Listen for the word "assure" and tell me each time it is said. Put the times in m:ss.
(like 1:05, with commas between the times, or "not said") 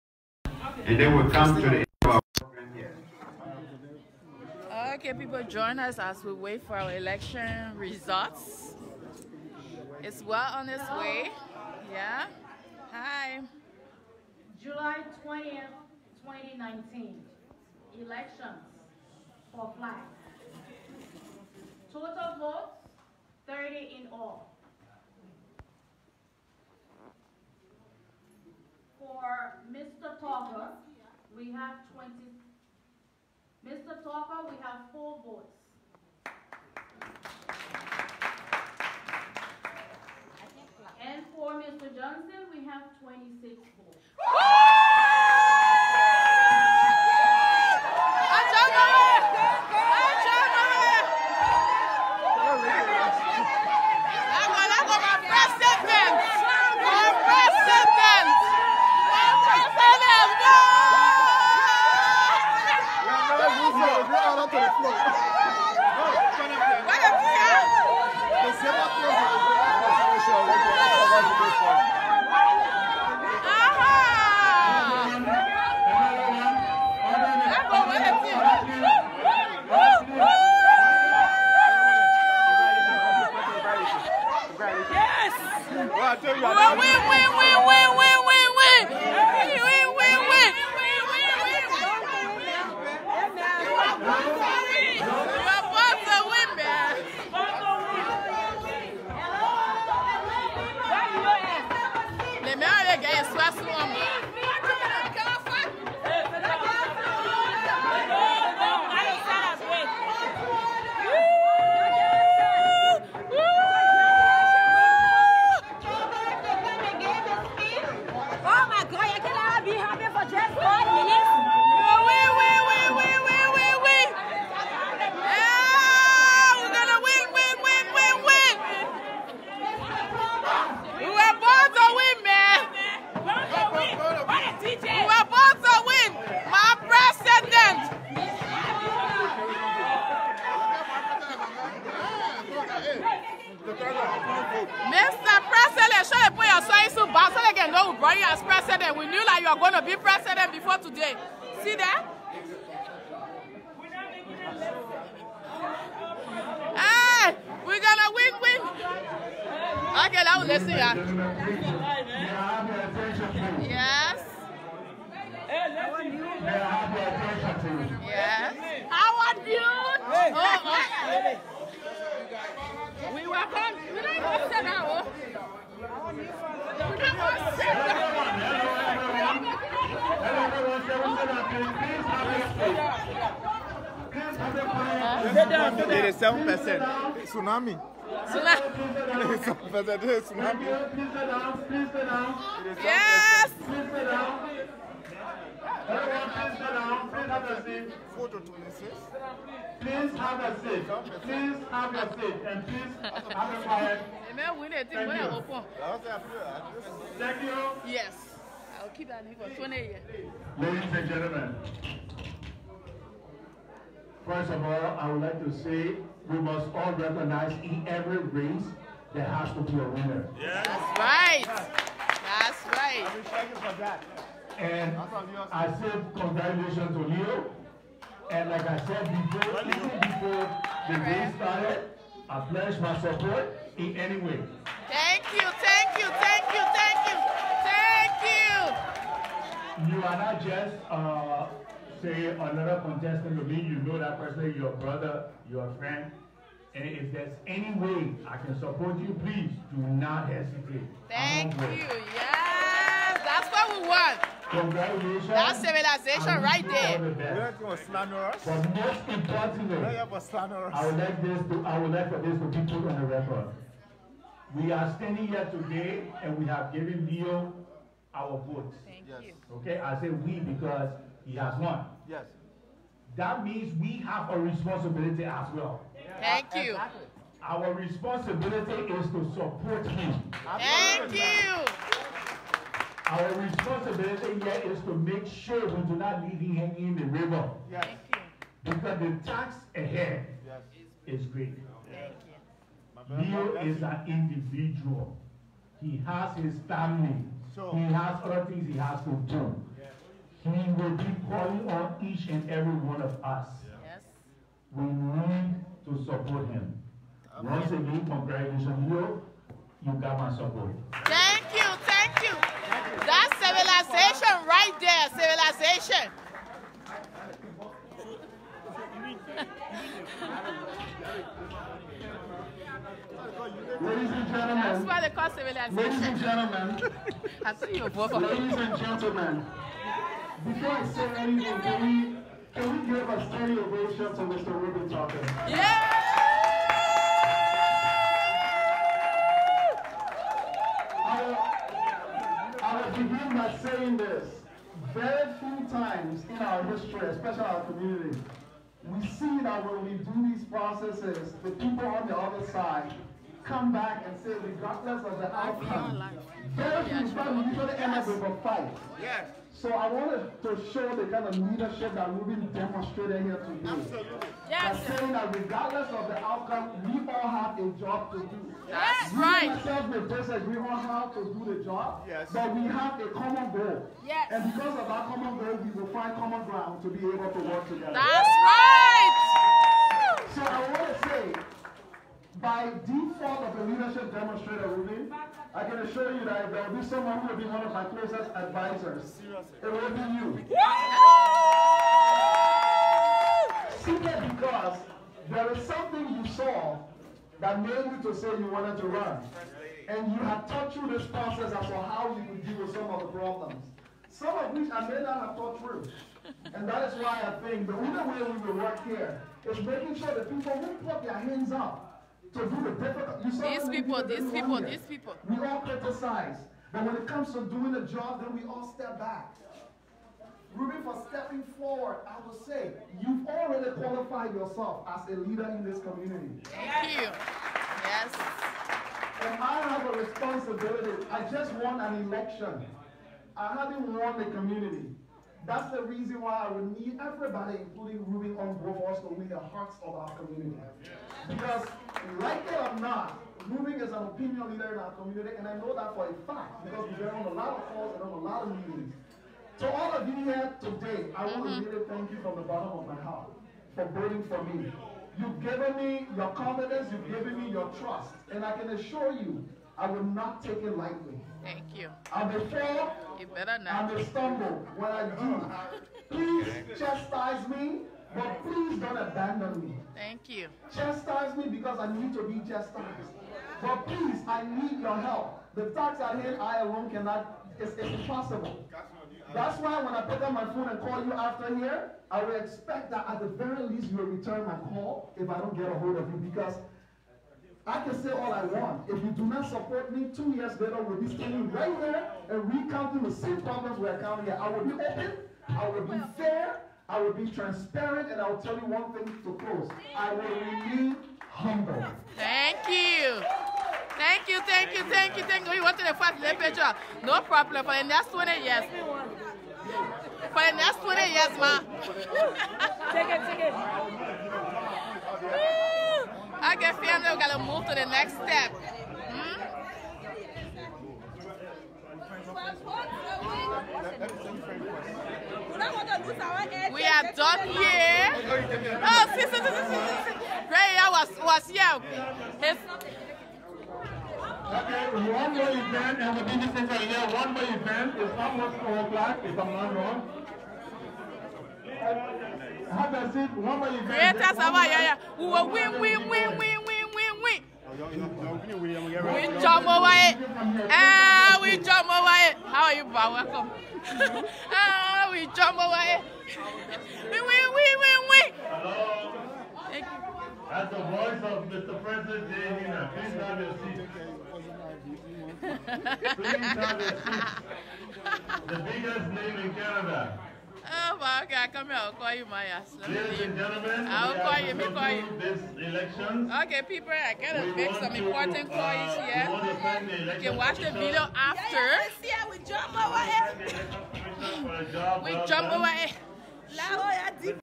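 6:25, 7:38.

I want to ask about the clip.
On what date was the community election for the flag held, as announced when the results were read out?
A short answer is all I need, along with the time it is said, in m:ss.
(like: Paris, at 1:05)
July 20th, 2019, at 0:14.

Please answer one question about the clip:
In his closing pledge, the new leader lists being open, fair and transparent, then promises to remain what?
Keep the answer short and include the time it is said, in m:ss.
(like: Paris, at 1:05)
humble, at 8:21.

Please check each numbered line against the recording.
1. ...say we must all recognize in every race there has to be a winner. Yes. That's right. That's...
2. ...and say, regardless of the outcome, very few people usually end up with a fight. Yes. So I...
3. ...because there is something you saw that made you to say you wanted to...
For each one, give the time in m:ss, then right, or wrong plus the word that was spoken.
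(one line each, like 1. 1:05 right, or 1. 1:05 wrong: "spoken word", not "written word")
1. 3:35 right
2. 5:54 right
3. 6:34 right.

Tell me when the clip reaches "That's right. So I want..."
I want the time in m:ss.
6:17.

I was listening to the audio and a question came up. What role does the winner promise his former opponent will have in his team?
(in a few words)
one of my closest advisors.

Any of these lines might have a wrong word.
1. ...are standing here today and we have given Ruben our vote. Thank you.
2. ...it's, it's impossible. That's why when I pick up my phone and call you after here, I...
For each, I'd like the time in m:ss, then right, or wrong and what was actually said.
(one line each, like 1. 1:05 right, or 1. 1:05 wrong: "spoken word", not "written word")
1. 4:24 wrong: "Leo", not "Ruben"
2. 7:57 right.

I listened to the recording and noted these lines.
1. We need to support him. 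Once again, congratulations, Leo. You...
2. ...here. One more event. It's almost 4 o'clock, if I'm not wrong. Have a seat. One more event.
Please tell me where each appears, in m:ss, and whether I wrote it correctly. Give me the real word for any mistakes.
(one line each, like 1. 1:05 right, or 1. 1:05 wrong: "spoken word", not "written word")
1. 5:04 right
2. 8:56 right.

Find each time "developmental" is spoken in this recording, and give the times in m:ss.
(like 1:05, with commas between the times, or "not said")
not said.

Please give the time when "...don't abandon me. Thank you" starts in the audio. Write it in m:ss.
7:48.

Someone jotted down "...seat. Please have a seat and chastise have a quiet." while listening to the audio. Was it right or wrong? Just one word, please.
wrong.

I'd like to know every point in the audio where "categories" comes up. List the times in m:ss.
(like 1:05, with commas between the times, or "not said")
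not said.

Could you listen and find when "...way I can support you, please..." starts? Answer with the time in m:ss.
4:07.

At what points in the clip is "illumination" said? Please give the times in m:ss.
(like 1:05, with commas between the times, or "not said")
not said.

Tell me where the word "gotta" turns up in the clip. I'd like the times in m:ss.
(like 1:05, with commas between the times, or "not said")
8:37, 9:37.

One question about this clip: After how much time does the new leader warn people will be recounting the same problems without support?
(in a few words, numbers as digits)
two years.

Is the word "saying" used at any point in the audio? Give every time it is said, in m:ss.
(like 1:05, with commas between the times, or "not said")
5:43, 6:04.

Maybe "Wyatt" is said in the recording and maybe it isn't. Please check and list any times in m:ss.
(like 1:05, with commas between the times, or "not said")
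9:11, 9:16.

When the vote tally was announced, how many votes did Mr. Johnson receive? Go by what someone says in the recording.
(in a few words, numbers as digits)
26.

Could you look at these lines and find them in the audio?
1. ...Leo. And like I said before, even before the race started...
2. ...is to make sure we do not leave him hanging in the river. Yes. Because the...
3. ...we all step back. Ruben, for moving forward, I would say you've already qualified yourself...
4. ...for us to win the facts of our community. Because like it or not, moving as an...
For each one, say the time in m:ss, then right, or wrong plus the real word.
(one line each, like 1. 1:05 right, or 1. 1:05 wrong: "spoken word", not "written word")
1. 3:47 right
2. 4:44 right
3. 6:58 wrong: "stepping", not "moving"
4. 7:18 wrong: "hearts", not "facts".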